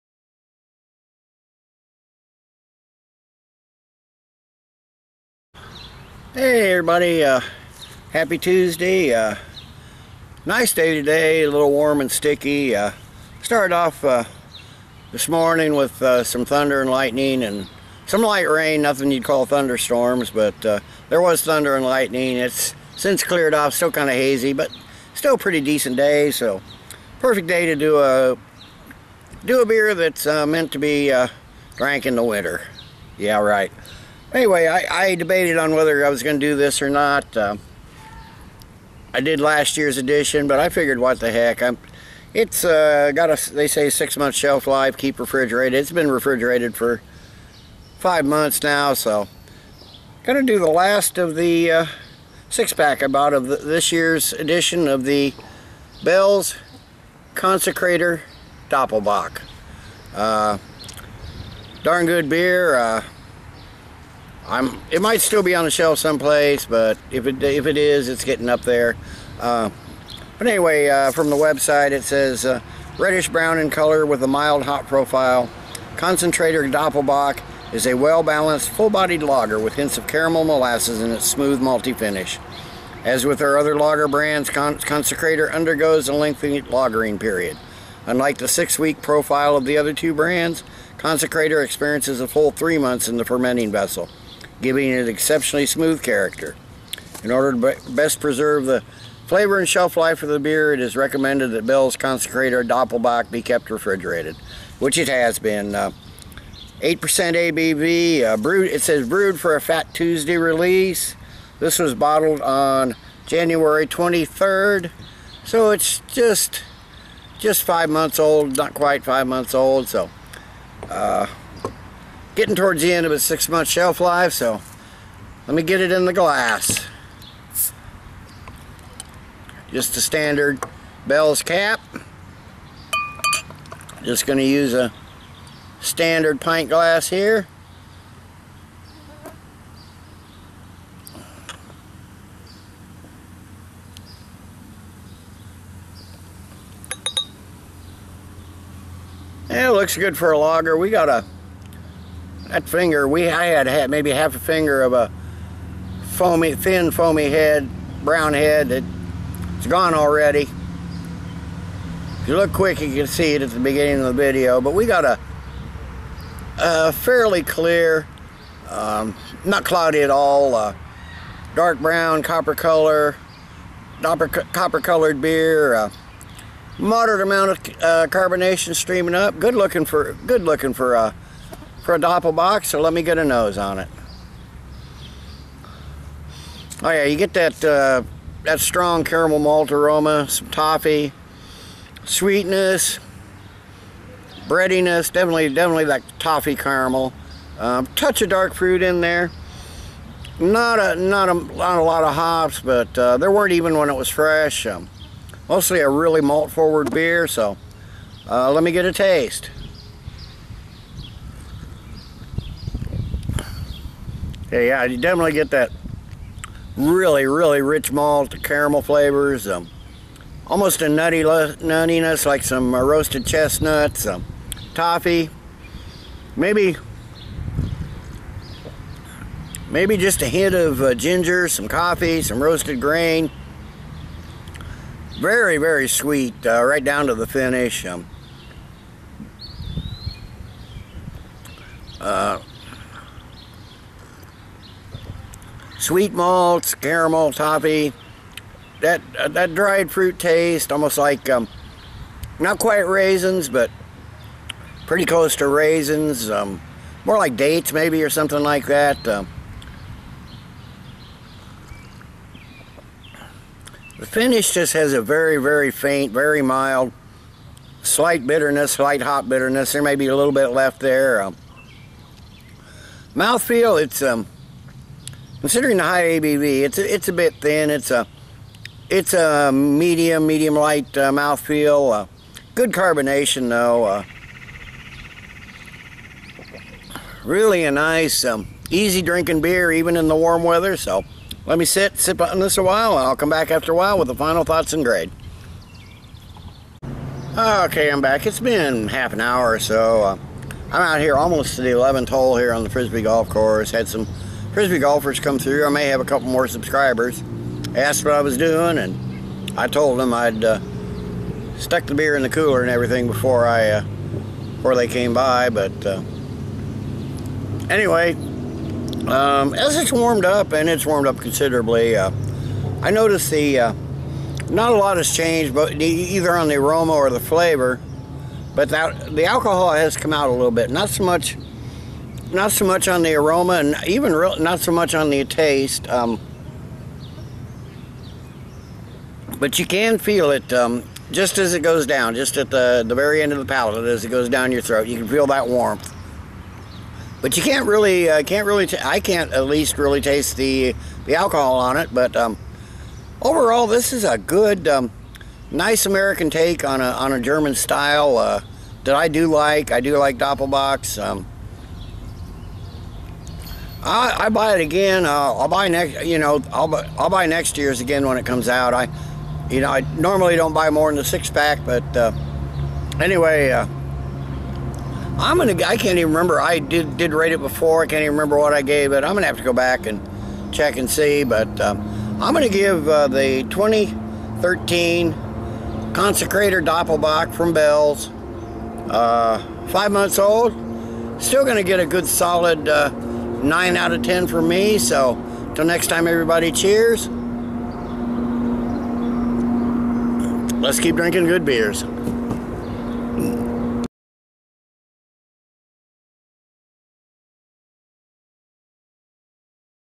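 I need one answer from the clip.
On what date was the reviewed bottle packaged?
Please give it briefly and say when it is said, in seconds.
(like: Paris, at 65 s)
January 23rd, at 113 s.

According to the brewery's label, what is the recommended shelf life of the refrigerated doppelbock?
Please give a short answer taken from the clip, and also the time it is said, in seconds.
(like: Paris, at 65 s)
6 months, at 43 s.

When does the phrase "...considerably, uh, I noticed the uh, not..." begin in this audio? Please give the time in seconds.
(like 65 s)
321 s.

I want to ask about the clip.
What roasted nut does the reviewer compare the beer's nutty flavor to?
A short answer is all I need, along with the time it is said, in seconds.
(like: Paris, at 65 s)
Chestnuts, at 222 s.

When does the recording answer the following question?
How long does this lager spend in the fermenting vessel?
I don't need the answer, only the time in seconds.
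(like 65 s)
92 s.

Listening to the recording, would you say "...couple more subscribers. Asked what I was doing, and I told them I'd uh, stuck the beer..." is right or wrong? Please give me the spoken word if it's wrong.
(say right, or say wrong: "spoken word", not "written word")
right.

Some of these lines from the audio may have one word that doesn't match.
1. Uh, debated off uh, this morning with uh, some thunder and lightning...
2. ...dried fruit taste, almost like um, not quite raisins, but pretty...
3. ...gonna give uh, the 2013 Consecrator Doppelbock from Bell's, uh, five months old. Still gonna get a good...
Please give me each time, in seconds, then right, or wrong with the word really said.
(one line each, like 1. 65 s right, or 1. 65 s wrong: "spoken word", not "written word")
1. 12 s wrong: "started", not "debated"
2. 249 s right
3. 382 s right.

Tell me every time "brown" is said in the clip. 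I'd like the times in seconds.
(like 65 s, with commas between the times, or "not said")
73 s, 158 s, 171 s.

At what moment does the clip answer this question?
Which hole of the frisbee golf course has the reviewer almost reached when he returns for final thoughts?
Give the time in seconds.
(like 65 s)
301 s.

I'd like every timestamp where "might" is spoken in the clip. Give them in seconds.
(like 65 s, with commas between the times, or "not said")
65 s.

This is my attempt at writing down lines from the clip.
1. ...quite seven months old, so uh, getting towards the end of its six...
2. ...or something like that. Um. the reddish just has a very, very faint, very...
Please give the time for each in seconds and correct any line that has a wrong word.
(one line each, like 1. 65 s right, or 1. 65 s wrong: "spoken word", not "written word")
1. 118 s wrong: "five", not "seven"
2. 258 s wrong: "finish", not "reddish".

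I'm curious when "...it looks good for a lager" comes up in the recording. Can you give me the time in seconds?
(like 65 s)
149 s.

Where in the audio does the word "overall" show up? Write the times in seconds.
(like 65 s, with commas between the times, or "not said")
353 s.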